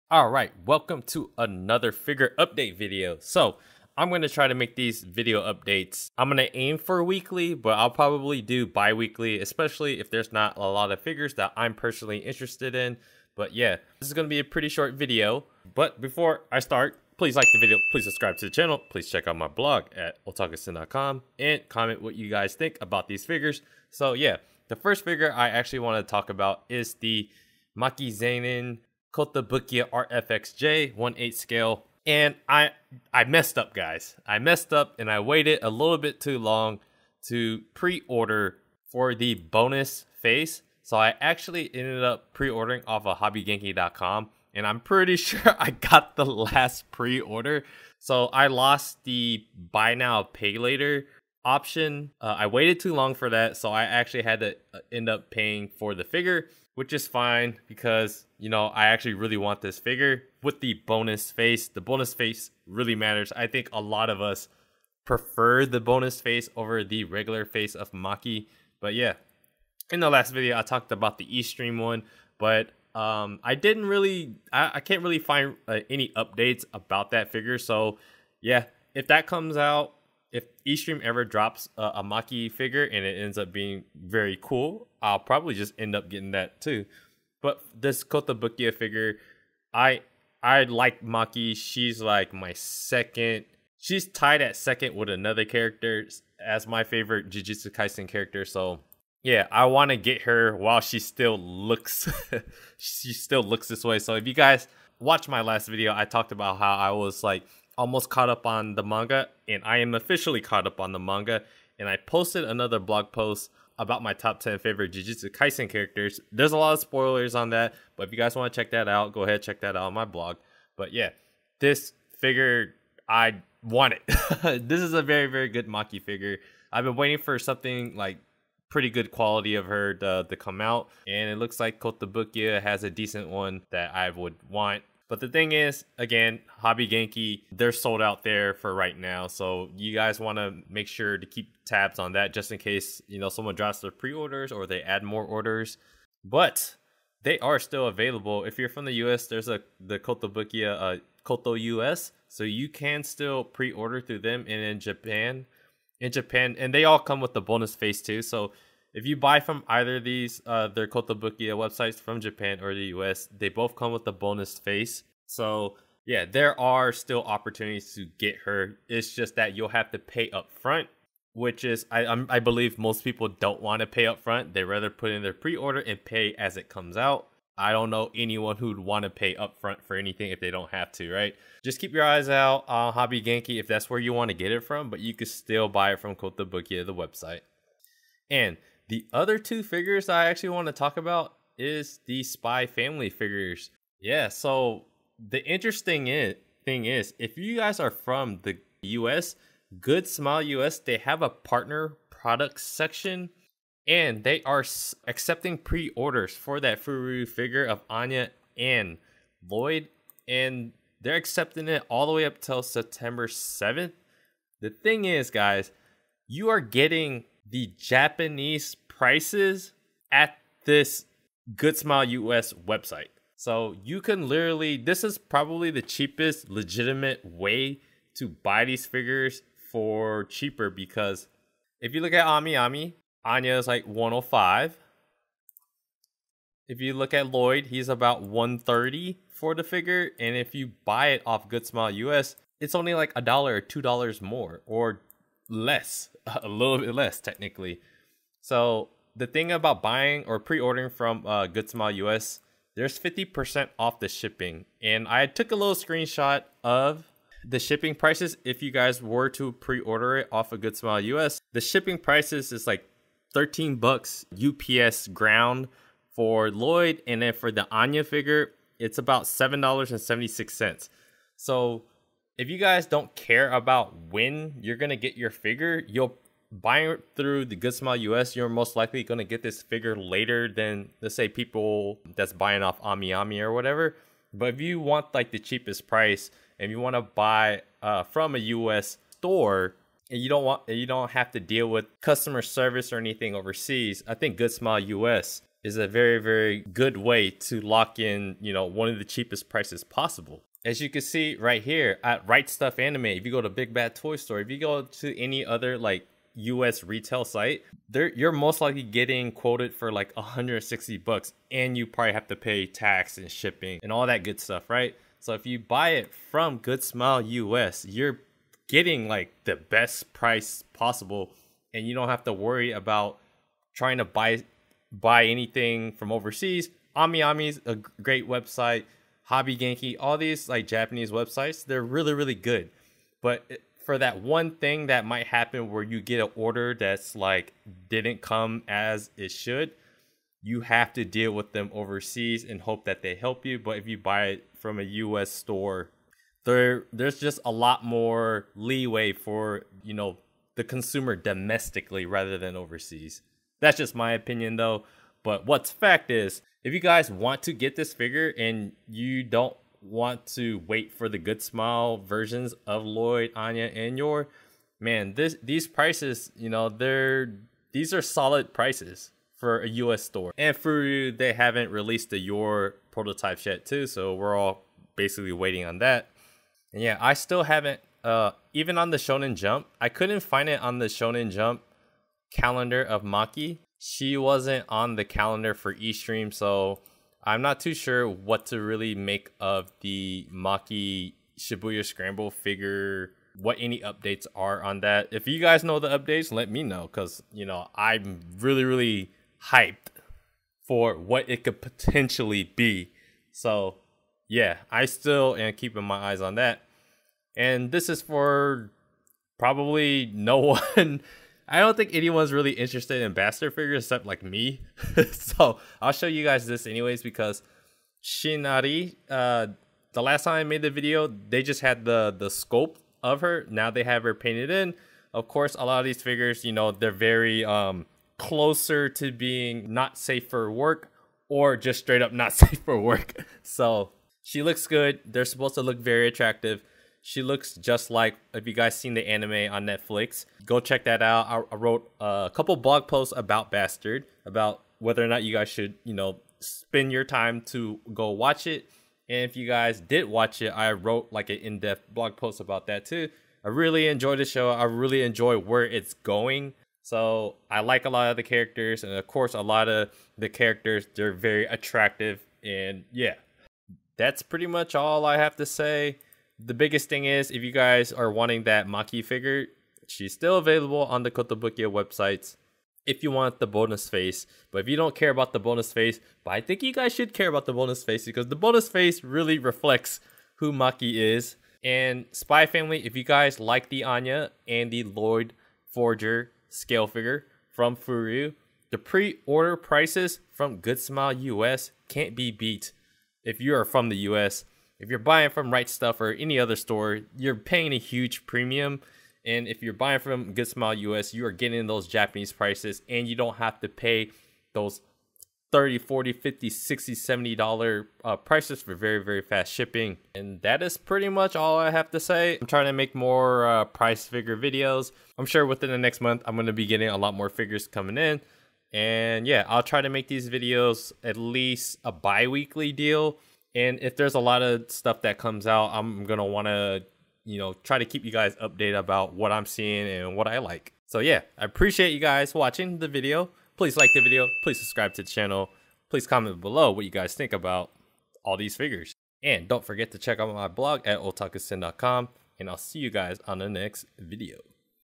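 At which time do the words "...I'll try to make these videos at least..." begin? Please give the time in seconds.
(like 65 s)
519 s.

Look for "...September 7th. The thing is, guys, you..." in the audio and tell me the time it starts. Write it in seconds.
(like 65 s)
212 s.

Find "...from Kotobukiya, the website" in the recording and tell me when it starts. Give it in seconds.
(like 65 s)
185 s.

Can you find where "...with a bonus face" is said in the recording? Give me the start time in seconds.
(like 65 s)
163 s.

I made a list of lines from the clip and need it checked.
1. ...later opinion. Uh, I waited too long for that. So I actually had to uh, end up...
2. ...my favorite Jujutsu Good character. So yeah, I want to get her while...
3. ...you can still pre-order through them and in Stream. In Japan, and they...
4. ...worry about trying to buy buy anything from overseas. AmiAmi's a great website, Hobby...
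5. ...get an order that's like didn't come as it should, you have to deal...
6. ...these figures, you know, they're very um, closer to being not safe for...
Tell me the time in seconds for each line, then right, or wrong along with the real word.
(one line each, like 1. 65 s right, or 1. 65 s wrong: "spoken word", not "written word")
1. 50 s wrong: "option", not "opinion"
2. 96 s wrong: "Kaisen", not "Good"
3. 152 s wrong: "Japan", not "Stream"
4. 322 s right
5. 335 s right
6. 425 s right.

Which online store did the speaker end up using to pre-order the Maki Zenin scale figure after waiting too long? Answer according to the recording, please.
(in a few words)
hobbygenki.com.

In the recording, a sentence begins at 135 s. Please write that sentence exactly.
But the thing is, again, Hobby Genki, they're sold out there for right now.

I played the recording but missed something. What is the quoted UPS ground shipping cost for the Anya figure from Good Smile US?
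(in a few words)
$7.76.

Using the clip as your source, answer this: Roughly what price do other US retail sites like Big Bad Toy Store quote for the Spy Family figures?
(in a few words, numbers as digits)
160 bucks.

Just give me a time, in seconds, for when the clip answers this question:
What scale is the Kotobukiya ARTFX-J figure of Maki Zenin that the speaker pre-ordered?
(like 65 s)
30 s.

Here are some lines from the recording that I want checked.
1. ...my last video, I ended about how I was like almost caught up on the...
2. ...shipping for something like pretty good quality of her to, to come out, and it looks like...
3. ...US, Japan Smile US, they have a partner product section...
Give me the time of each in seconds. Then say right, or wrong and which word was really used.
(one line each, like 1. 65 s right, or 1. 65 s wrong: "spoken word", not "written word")
1. 105 s wrong: "talked", not "ended"
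2. 126 s wrong: "waiting", not "shipping"
3. 198 s wrong: "Good", not "Japan".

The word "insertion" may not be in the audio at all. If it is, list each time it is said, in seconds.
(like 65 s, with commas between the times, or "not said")
not said.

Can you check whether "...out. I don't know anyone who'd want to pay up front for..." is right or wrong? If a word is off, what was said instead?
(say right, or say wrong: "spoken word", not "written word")
right.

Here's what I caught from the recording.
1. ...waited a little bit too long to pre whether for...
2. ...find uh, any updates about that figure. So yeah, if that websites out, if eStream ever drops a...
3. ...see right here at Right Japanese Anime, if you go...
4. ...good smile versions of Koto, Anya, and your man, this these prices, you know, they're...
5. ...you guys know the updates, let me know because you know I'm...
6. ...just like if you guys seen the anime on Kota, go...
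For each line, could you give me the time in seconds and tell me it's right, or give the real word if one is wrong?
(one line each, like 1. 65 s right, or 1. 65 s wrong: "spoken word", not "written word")
1. 35 s wrong: "order", not "whether"
2. 75 s wrong: "comes", not "websites"
3. 301 s wrong: "Stuff", not "Japanese"
4. 361 s wrong: "Loid", not "Koto"
5. 395 s right
6. 437 s wrong: "Netflix", not "Kota".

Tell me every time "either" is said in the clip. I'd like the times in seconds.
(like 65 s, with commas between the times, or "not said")
159 s.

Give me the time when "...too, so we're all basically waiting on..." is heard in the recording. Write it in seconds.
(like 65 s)
373 s.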